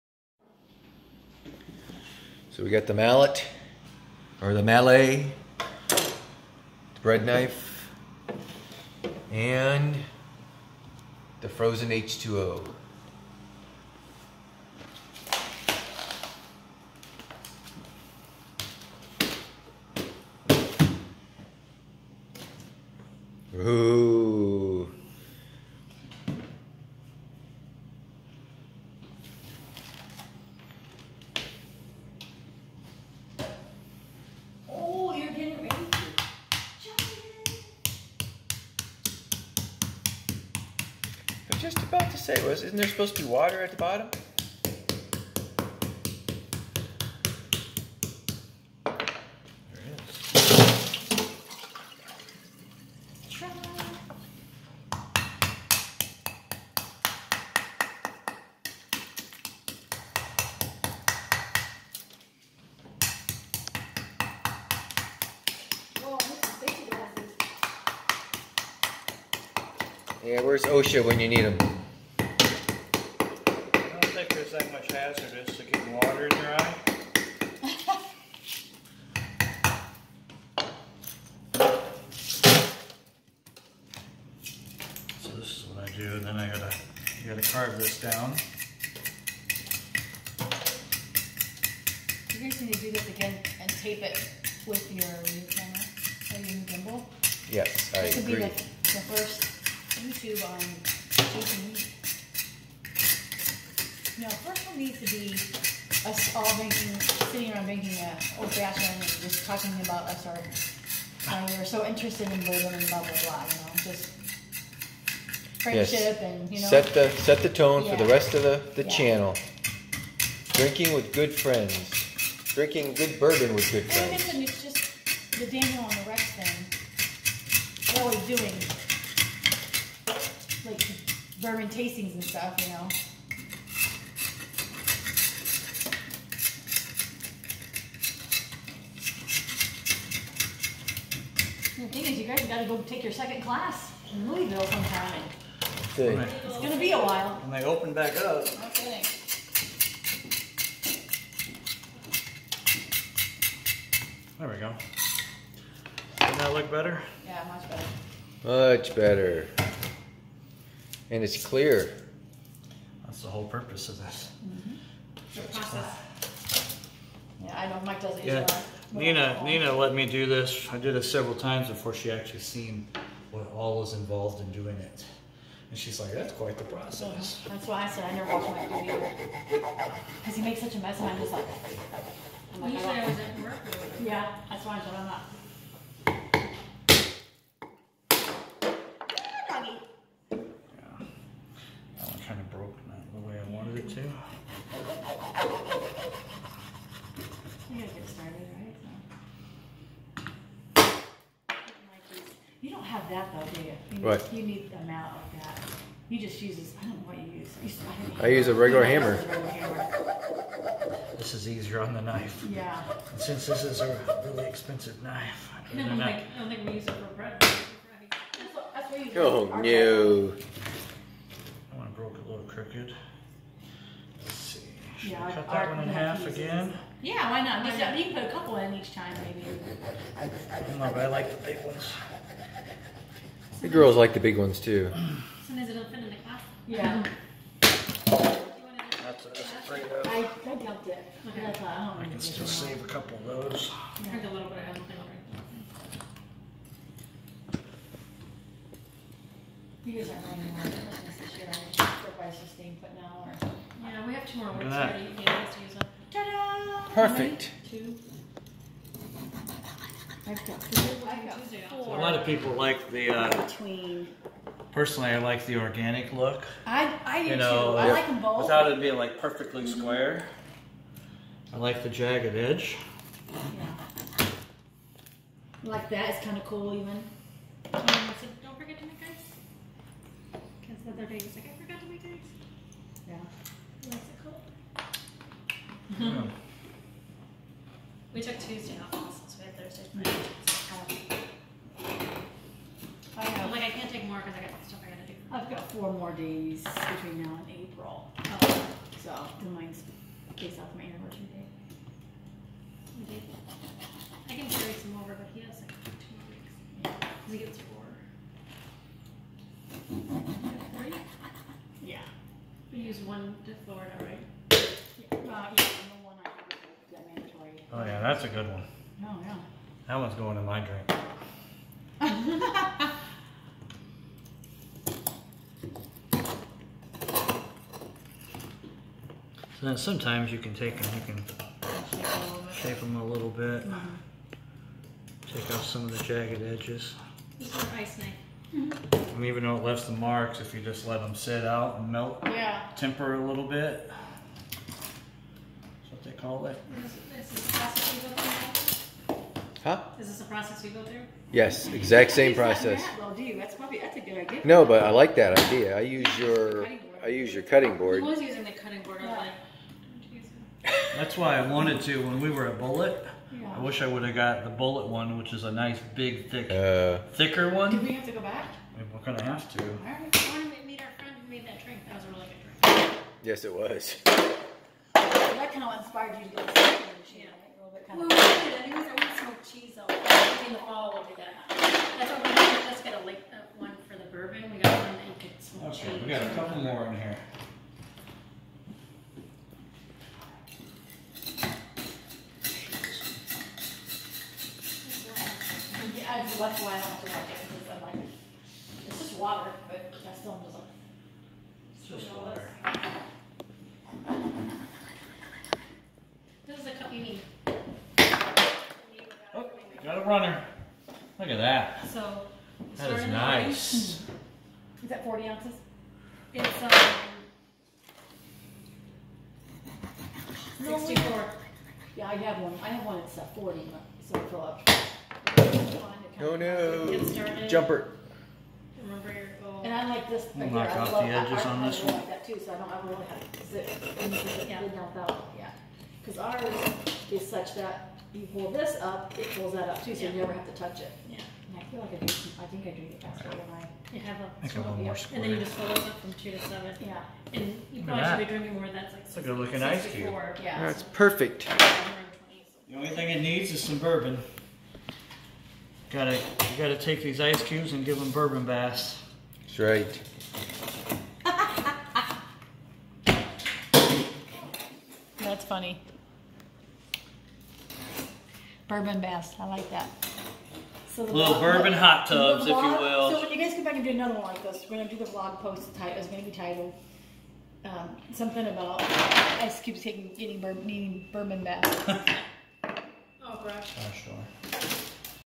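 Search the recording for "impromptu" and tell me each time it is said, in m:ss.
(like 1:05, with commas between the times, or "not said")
not said.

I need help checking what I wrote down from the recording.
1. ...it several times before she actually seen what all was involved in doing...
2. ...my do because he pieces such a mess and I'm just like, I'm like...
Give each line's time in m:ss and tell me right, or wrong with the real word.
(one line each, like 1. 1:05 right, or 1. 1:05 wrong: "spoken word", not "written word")
1. 2:50 right
2. 2:58 wrong: "makes", not "pieces".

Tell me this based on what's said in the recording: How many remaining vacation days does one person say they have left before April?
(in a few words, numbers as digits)
4.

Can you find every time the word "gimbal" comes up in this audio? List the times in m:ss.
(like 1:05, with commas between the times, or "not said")
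1:36.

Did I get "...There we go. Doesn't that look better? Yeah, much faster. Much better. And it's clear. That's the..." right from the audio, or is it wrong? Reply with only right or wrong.
wrong.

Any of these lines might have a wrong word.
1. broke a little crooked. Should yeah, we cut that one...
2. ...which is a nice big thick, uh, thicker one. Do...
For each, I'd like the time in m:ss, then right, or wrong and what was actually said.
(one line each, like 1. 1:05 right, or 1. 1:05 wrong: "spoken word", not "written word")
1. 3:41 right
2. 6:05 right.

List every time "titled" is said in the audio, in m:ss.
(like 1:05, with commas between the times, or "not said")
7:56.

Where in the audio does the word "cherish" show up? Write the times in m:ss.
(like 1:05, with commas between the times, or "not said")
not said.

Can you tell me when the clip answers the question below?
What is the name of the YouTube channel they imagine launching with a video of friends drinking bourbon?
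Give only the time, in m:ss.
1:41.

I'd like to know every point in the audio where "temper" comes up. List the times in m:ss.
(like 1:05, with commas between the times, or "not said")
5:42.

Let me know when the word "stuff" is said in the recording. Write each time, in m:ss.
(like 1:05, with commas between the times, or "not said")
2:12, 4:54.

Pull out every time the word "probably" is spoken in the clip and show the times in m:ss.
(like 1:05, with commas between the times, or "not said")
5:53, 7:27.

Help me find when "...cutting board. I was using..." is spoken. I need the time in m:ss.
5:57.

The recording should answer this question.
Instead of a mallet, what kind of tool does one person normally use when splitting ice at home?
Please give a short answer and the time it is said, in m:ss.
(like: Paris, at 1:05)
a regular hammer, at 3:28.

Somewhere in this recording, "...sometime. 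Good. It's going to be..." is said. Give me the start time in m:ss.
2:24.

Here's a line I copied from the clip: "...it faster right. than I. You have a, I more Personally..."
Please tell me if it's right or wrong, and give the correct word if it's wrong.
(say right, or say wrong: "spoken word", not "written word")
wrong: "And", not "Personally".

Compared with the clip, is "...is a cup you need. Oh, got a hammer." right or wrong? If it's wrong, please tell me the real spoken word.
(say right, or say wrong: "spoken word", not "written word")
wrong: "runner", not "hammer".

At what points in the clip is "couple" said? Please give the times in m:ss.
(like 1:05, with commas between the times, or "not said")
3:48, 4:02.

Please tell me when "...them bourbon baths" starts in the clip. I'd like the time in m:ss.
7:37.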